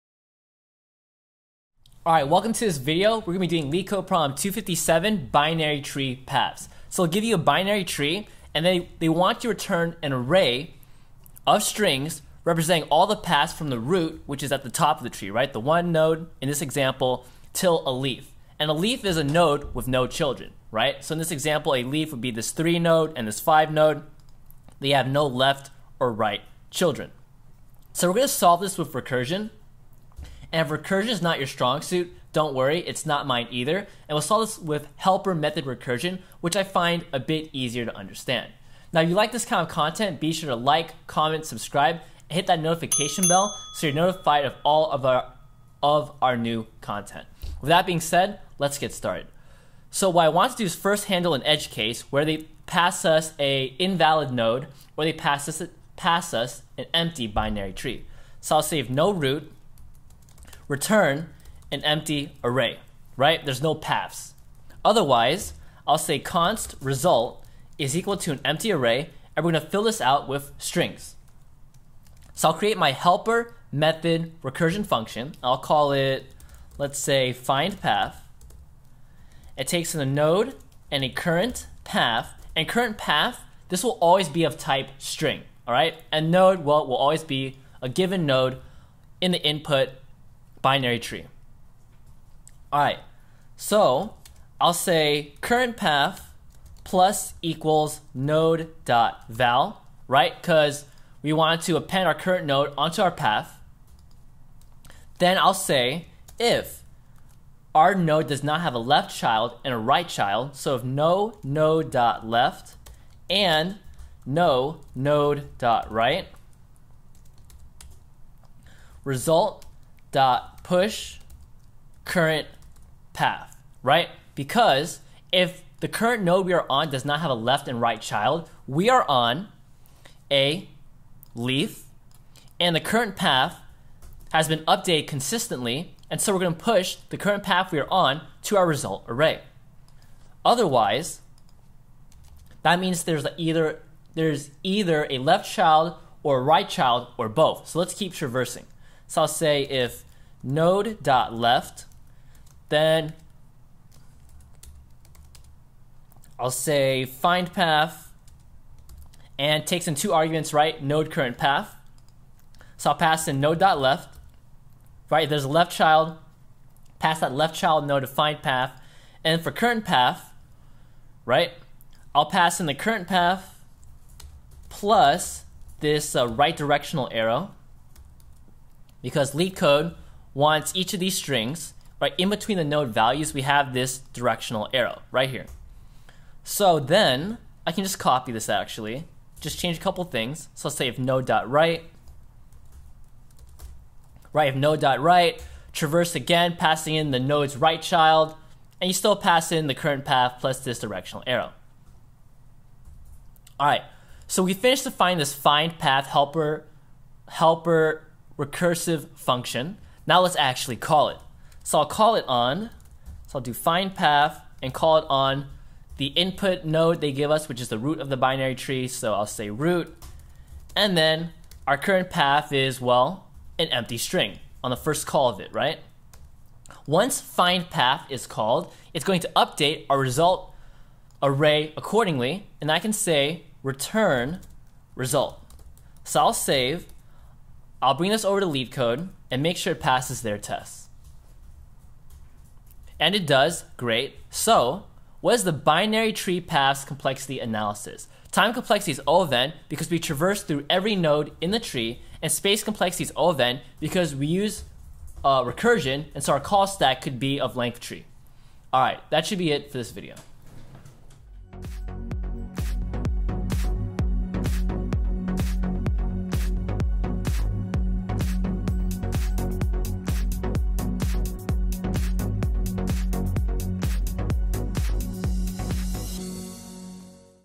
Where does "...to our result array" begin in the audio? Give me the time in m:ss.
2:18.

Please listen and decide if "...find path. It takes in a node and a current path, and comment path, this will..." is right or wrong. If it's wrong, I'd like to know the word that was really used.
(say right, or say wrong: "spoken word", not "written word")
wrong: "current", not "comment".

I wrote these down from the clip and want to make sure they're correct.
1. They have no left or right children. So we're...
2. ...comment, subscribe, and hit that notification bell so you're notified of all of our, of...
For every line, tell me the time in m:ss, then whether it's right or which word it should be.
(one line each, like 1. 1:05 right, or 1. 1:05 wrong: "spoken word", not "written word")
1. 0:24 right
2. 0:41 right.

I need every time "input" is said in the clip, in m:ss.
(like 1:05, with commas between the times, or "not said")
1:29, 3:36.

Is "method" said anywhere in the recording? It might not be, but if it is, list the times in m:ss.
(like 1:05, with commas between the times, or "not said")
0:35, 1:13.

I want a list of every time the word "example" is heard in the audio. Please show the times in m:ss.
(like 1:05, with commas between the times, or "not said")
0:16, 0:21.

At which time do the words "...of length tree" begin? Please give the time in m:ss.
4:17.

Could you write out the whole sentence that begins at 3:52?
And I can say return result.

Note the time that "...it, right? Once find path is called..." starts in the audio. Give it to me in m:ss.
3:45.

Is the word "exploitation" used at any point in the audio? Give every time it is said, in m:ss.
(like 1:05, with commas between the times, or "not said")
not said.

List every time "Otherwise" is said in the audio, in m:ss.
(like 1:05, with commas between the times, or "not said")
1:04, 2:20.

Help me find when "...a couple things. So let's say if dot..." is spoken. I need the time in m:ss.
3:09.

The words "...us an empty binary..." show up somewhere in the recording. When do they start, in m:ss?
0:56.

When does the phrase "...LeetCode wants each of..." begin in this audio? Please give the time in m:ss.
2:59.